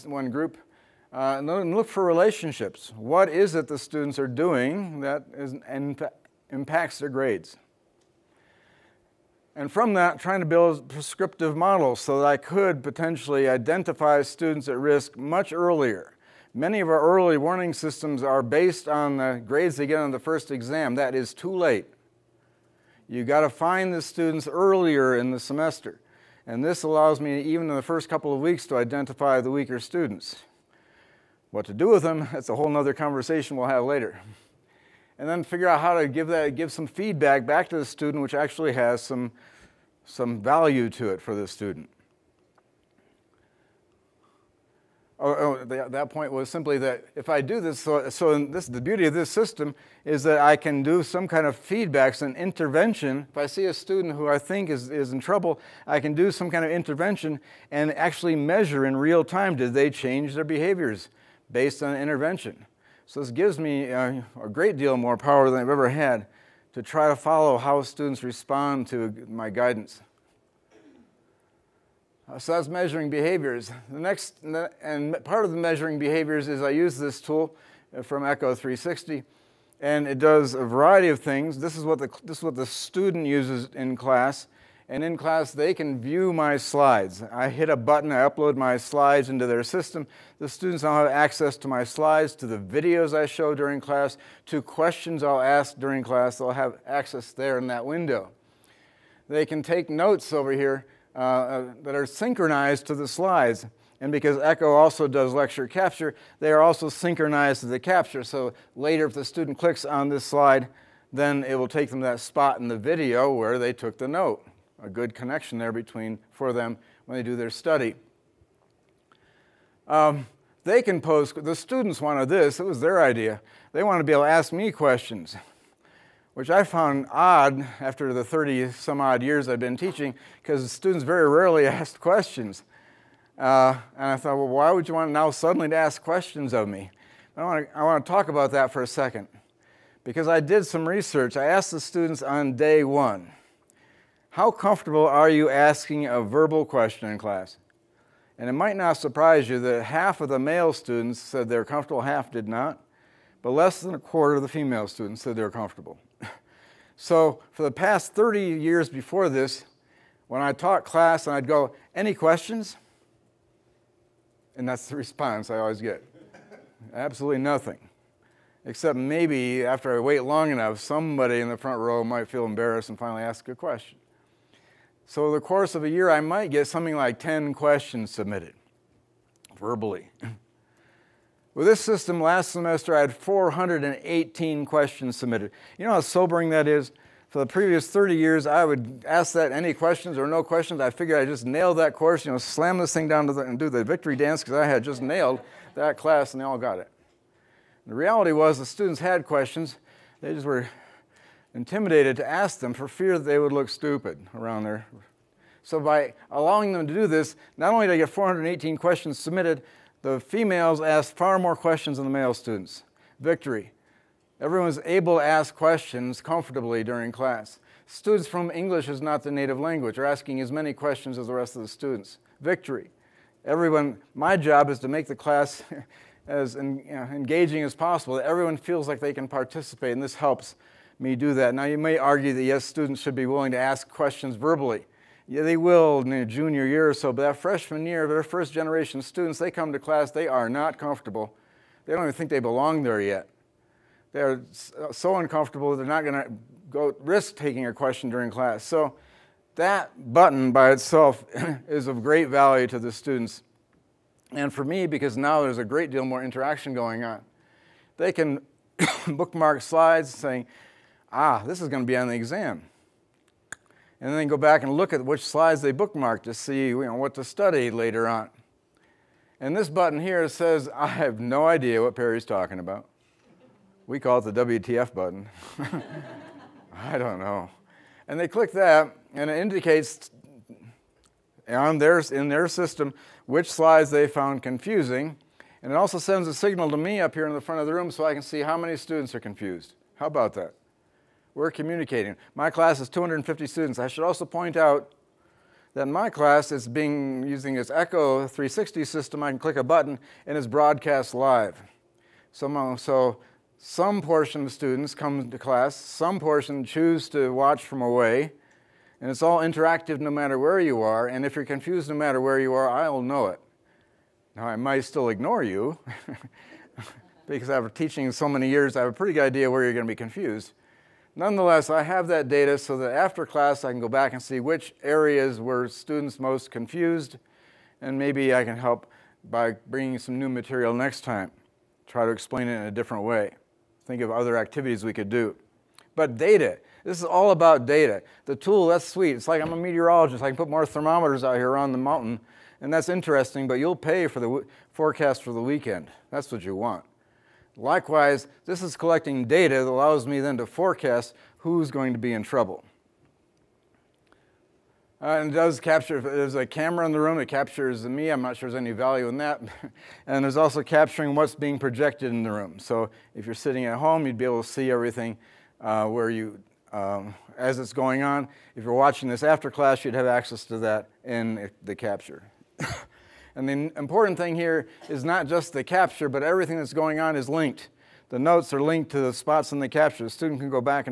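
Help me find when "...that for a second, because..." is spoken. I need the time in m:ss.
2:18.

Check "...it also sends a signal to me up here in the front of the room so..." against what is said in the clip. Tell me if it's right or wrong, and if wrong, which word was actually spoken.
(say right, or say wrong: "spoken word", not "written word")
right.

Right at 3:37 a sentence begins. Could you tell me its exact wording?
Students from English is not the native language are asking as many questions as the rest of the students.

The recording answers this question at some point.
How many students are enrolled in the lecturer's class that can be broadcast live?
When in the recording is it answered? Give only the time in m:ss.
4:52.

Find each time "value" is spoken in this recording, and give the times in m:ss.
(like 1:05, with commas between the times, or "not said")
0:40, 4:12, 5:58.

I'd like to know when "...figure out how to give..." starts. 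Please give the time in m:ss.
0:35.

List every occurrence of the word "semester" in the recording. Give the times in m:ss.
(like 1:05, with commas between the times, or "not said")
0:25, 3:02.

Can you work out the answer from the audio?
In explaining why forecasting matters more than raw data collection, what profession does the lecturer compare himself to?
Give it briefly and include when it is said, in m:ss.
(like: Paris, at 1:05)
meteorologist, at 5:39.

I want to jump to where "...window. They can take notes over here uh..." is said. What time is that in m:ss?
1:37.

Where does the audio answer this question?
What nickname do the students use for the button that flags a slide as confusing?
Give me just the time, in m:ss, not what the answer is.
4:34.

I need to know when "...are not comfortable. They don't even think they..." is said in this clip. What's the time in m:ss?
4:00.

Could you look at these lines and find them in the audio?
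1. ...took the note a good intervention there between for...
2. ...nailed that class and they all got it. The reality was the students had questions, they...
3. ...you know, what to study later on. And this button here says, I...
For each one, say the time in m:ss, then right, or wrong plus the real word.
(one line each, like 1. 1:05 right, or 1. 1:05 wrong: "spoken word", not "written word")
1. 1:53 wrong: "connection", not "intervention"
2. 3:15 right
3. 4:26 right.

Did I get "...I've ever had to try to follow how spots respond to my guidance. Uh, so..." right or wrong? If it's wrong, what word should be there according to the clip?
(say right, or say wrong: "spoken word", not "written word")
wrong: "students", not "spots".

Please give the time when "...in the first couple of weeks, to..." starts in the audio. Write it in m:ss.
0:27.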